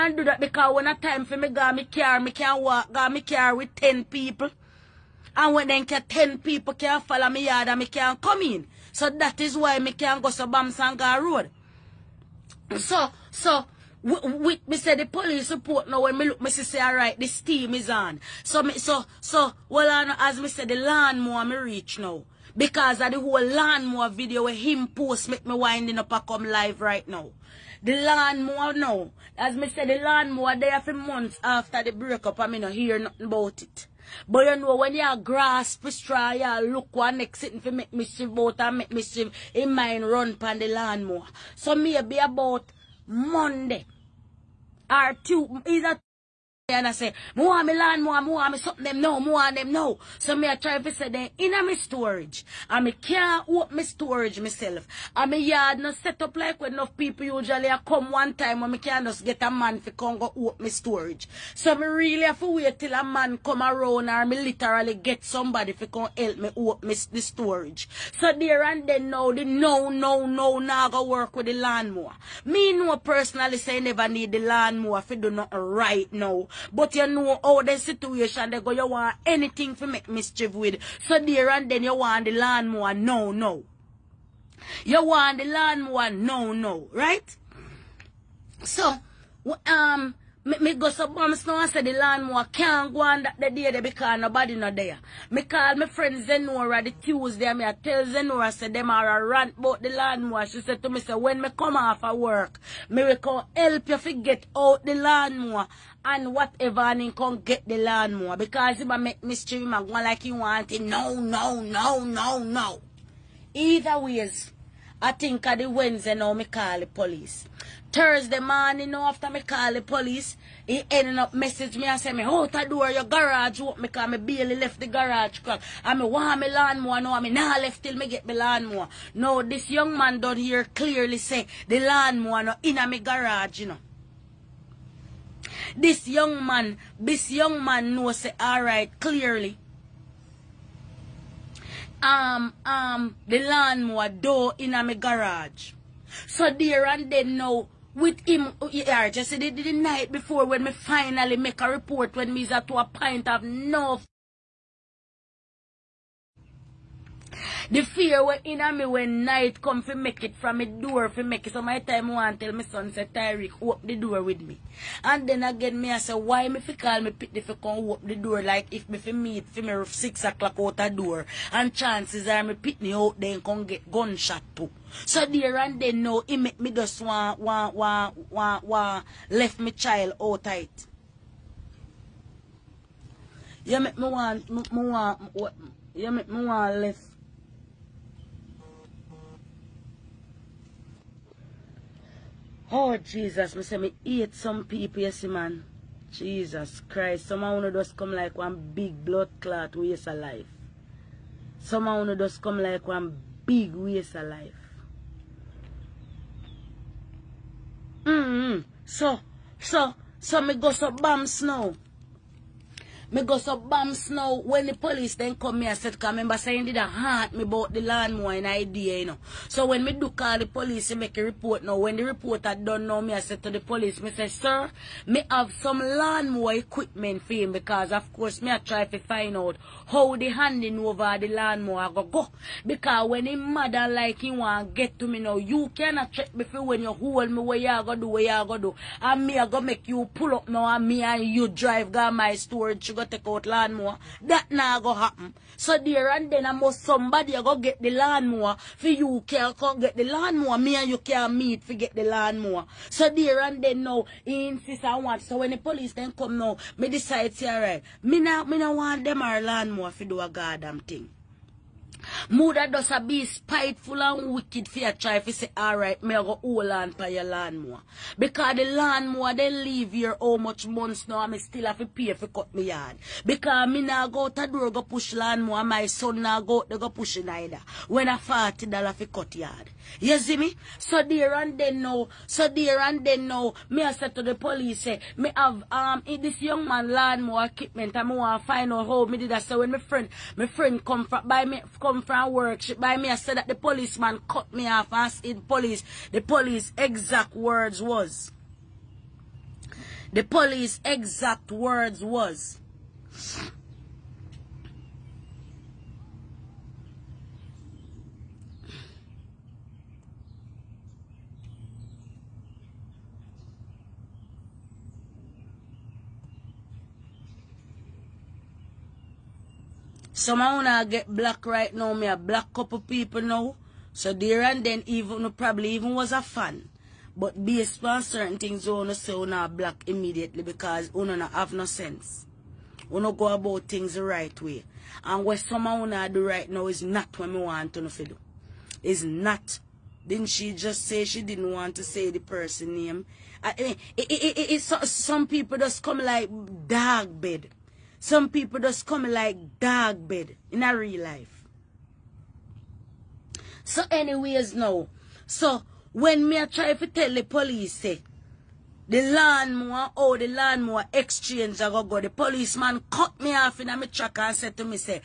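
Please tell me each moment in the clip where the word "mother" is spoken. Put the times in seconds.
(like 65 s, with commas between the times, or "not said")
233 s, 262 s.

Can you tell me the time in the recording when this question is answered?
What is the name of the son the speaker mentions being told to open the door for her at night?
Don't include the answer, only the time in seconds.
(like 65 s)
163 s.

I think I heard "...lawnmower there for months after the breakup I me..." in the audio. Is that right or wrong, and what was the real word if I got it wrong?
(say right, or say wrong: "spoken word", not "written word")
right.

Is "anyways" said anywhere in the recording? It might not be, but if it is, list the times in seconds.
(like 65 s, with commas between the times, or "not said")
353 s.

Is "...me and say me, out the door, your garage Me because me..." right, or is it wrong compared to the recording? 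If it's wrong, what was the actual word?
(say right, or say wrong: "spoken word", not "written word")
right.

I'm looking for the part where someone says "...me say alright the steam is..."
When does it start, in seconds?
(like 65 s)
16 s.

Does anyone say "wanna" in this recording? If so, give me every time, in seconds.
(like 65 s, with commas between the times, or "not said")
328 s, 335 s.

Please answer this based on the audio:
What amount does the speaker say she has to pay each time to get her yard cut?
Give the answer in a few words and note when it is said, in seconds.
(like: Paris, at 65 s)
$40, at 278 s.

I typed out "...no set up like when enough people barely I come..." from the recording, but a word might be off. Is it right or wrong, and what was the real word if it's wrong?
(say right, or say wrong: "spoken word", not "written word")
wrong: "usually", not "barely".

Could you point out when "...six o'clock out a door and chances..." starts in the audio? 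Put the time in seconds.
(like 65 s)
169 s.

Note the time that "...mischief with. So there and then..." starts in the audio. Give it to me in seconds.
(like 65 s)
80 s.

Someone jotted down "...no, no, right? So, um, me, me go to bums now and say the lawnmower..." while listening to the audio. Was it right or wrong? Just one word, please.
right.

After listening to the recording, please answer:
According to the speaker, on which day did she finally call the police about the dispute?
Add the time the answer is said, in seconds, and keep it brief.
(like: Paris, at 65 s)
Wednesday, at 115 s.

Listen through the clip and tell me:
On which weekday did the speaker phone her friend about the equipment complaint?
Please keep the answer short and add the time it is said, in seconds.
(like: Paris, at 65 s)
Tuesday, at 96 s.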